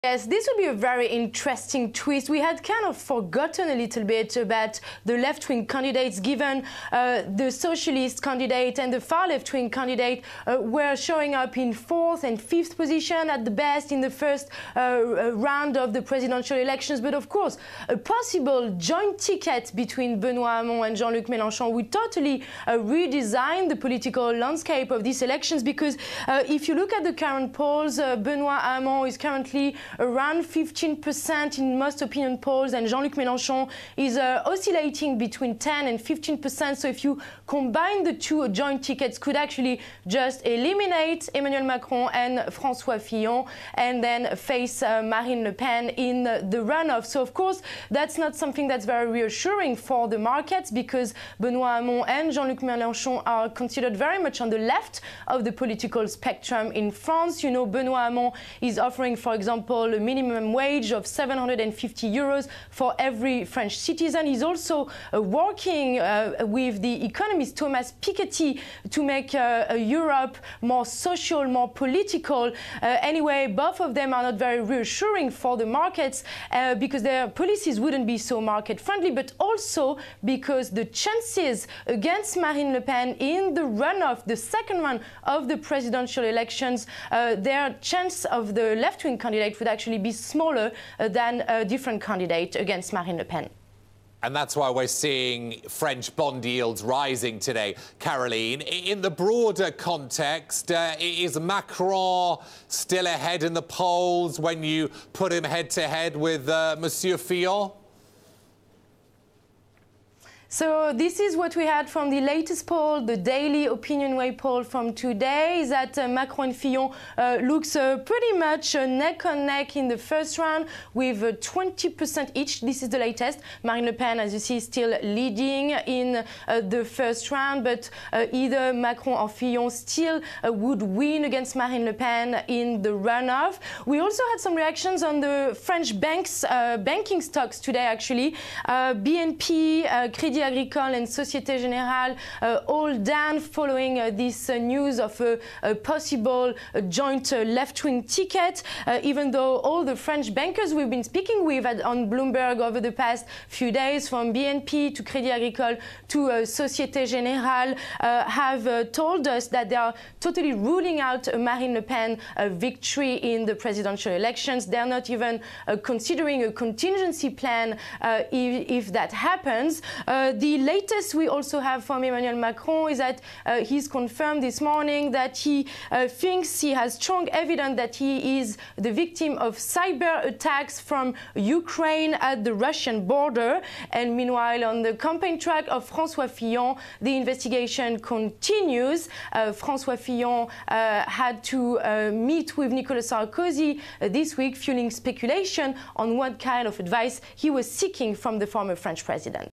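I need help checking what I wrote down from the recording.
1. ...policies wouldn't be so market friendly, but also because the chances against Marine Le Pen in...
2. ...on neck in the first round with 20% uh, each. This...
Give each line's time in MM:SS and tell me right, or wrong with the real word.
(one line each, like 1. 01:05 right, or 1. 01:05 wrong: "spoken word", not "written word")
1. 01:17 right
2. 01:59 right.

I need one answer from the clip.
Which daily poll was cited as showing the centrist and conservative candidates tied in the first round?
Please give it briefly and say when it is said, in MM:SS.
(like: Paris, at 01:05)
OpinionWay, at 01:53.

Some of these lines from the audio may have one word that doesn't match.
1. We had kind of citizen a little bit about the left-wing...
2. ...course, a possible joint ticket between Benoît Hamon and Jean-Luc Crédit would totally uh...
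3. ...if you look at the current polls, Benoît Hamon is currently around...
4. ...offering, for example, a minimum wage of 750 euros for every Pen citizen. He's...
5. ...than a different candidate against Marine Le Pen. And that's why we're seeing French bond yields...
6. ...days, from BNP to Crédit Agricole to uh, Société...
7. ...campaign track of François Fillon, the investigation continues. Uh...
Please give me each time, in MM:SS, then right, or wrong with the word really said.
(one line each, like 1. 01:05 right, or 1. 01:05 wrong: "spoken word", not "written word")
1. 00:02 wrong: "forgotten", not "citizen"
2. 00:17 wrong: "Mélenchon", not "Crédit"
3. 00:26 right
4. 00:58 wrong: "French", not "Pen"
5. 01:31 right
6. 02:33 right
7. 03:04 right.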